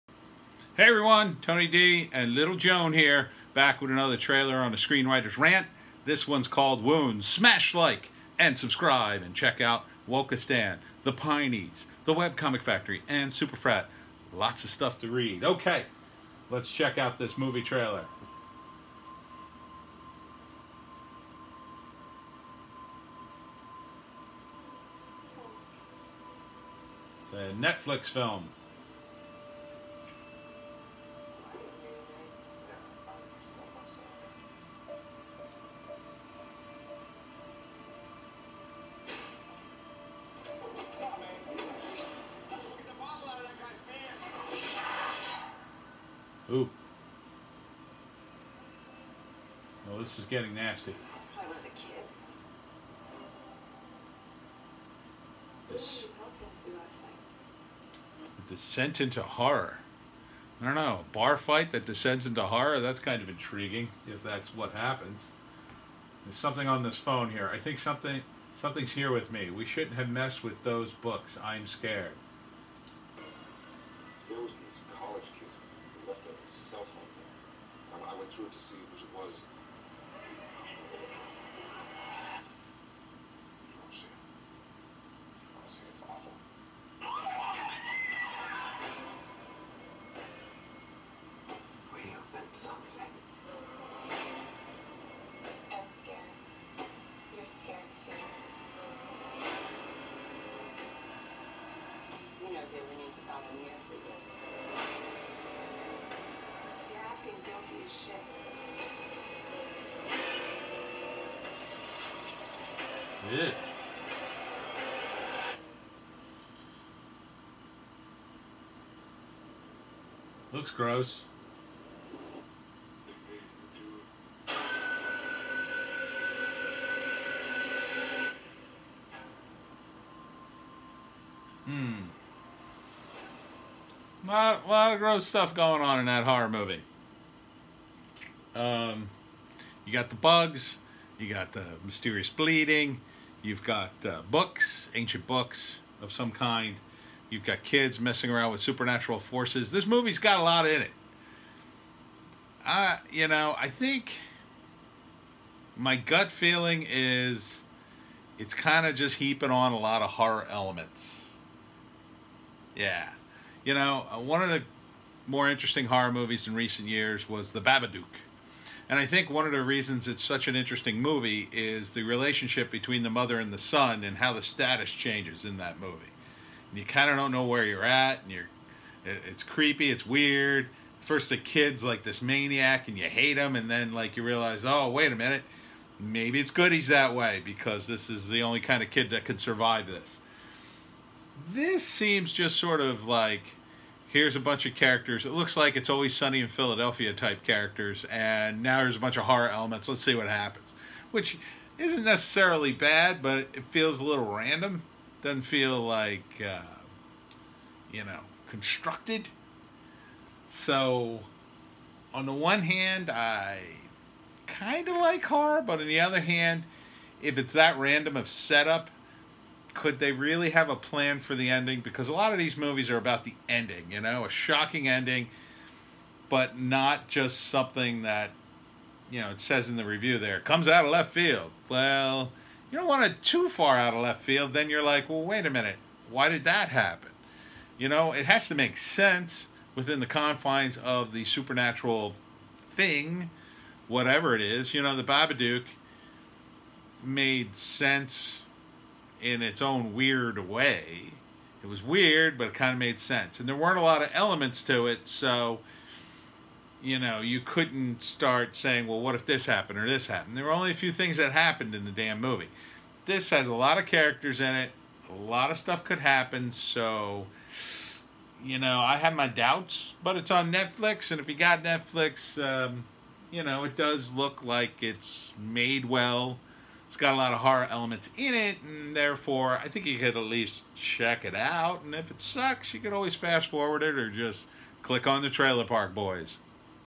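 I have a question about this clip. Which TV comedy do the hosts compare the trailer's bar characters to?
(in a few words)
It's Always Sunny in Philadelphia.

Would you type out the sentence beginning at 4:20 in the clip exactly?
There were only a few things that happened in the damn movie.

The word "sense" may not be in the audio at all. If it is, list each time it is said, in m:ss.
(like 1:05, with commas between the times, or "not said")
3:58, 4:07, 4:12.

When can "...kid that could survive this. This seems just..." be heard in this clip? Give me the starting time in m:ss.
3:08.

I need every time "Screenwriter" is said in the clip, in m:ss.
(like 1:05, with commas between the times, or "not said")
0:04.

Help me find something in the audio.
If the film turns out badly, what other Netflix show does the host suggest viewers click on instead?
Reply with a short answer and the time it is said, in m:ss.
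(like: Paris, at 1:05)
Trailer Park Boys, at 4:45.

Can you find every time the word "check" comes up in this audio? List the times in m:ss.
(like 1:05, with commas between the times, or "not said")
0:09, 0:16, 4:40.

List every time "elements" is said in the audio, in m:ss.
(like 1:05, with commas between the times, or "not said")
2:40, 3:19, 4:14, 4:37.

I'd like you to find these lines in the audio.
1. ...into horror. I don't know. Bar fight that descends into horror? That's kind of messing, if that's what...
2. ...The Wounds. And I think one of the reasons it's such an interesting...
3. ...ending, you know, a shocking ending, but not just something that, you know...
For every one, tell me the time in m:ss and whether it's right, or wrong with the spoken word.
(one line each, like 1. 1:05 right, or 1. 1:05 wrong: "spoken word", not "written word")
1. 0:58 wrong: "intriguing", not "messing"
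2. 2:47 wrong: "Babadook", not "Wounds"
3. 3:43 right.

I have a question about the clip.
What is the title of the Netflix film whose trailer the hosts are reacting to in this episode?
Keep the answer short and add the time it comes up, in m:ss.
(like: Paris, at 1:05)
Wounds, at 0:06.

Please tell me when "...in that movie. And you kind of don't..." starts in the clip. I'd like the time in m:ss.
2:55.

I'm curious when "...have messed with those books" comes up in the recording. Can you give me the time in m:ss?
1:09.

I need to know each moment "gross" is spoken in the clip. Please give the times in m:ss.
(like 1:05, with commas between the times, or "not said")
2:00, 2:14.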